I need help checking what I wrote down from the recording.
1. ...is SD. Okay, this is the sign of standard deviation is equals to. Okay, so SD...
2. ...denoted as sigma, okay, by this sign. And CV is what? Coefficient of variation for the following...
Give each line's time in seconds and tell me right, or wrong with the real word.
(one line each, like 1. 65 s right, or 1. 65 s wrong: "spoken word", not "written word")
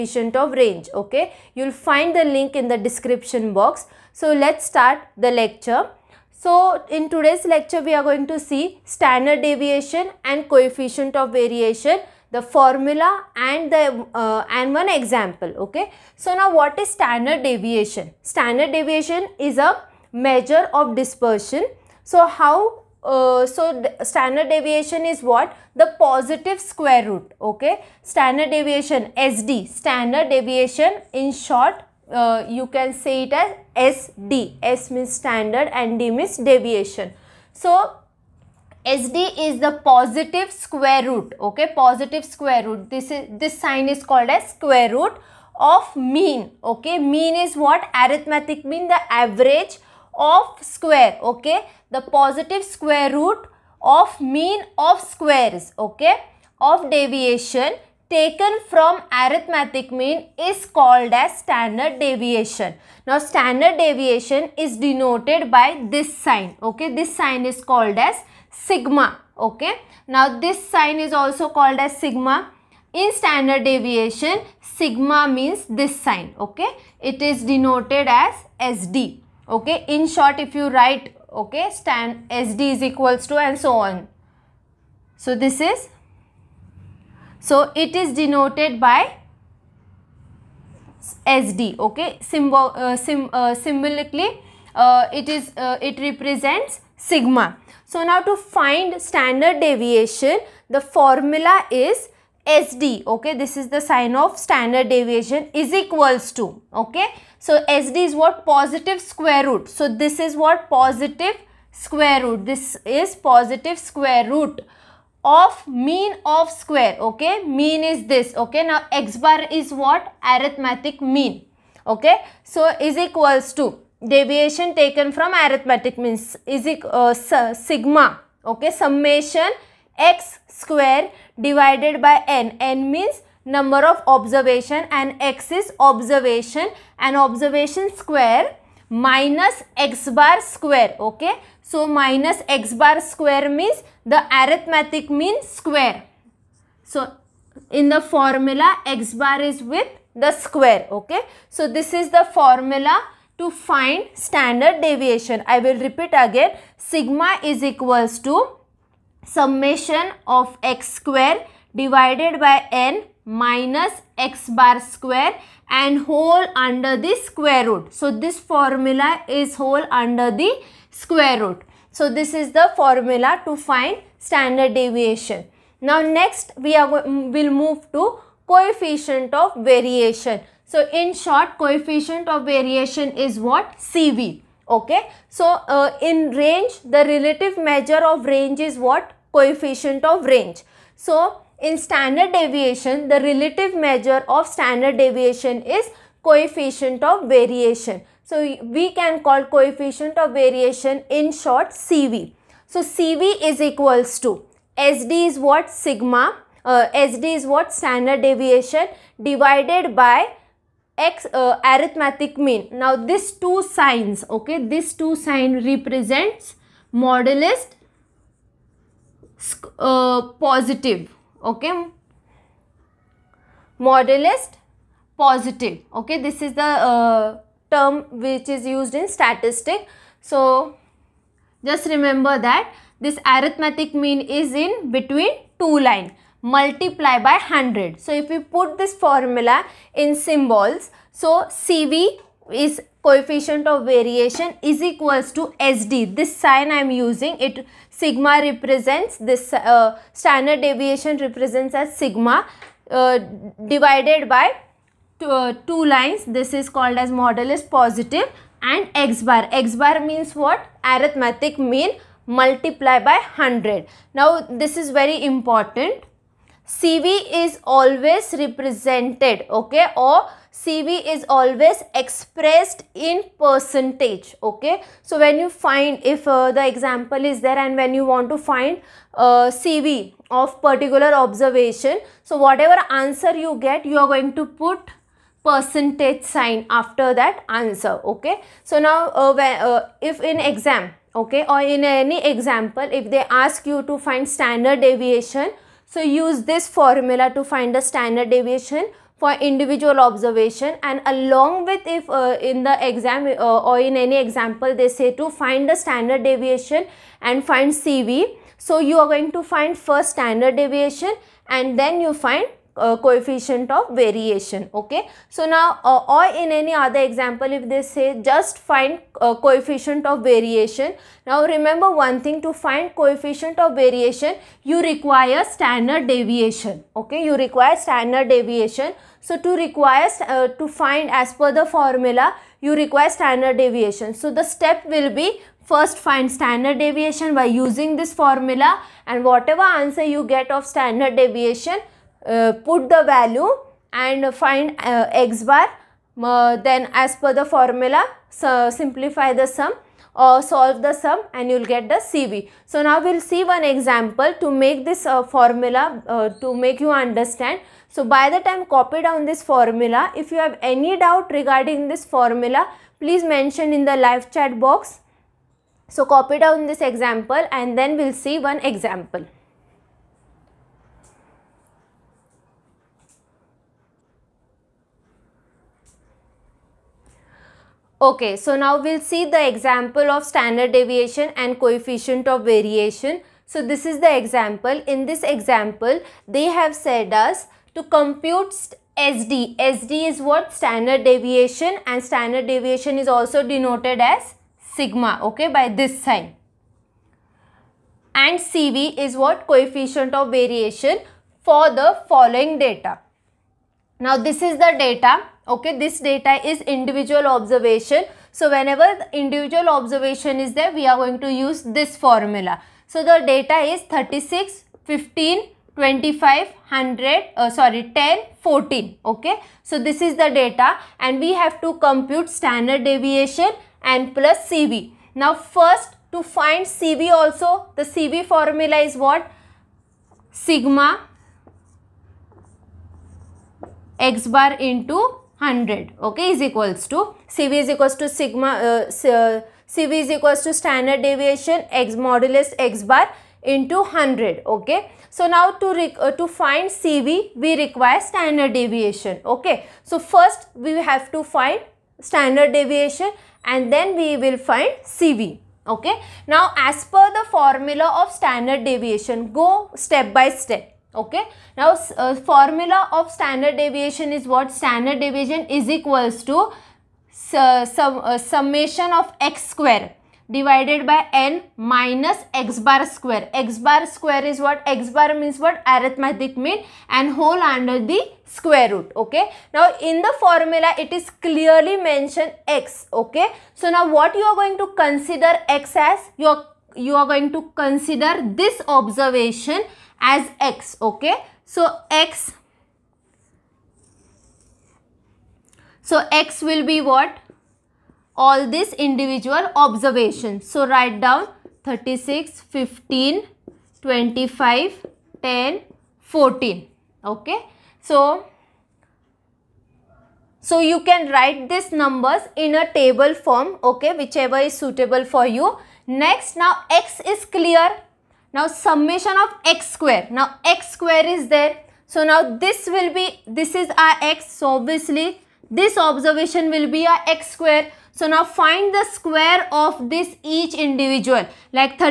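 1. 101 s right
2. 393 s right.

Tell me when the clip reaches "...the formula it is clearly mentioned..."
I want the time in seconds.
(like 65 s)
480 s.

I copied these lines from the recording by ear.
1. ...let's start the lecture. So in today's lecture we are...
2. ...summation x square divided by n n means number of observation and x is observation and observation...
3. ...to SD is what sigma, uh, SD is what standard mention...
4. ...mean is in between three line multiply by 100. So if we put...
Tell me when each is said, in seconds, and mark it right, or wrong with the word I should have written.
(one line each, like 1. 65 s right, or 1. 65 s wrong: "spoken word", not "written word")
1. 4 s right
2. 128 s right
3. 204 s wrong: "deviation", not "mention"
4. 233 s wrong: "two", not "three".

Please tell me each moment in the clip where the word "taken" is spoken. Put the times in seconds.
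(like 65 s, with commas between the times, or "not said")
58 s, 124 s.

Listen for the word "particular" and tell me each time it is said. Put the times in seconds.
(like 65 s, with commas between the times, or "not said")
280 s.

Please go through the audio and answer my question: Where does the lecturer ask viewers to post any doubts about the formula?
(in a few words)
Live chat box.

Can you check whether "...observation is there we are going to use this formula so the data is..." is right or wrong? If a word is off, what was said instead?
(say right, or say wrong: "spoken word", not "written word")
right.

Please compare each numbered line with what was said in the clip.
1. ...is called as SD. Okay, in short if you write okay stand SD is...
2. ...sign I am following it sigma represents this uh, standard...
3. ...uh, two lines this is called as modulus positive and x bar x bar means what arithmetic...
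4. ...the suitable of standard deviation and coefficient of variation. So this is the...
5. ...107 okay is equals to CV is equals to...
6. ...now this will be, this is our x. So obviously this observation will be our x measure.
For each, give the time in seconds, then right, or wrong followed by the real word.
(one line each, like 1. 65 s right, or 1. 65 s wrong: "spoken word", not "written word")
1. 77 s wrong: "denoted", not "called"
2. 246 s wrong: "using", not "following"
3. 255 s right
4. 379 s wrong: "example", not "suitable"
5. 435 s wrong: "100", not "107"
6. 522 s wrong: "square", not "measure".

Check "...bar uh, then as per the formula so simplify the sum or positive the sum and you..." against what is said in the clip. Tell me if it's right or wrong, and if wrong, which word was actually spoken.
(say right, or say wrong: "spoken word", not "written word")
wrong: "solve", not "positive".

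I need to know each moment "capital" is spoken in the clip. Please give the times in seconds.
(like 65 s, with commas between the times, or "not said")
not said.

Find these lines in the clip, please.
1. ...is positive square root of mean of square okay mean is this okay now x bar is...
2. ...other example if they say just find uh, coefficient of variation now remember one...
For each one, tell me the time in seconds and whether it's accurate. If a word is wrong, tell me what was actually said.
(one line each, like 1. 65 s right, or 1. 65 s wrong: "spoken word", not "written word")
1. 112 s right
2. 316 s right.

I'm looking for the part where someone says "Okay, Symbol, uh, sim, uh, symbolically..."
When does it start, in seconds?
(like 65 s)
91 s.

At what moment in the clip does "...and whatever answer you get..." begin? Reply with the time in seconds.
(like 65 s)
339 s.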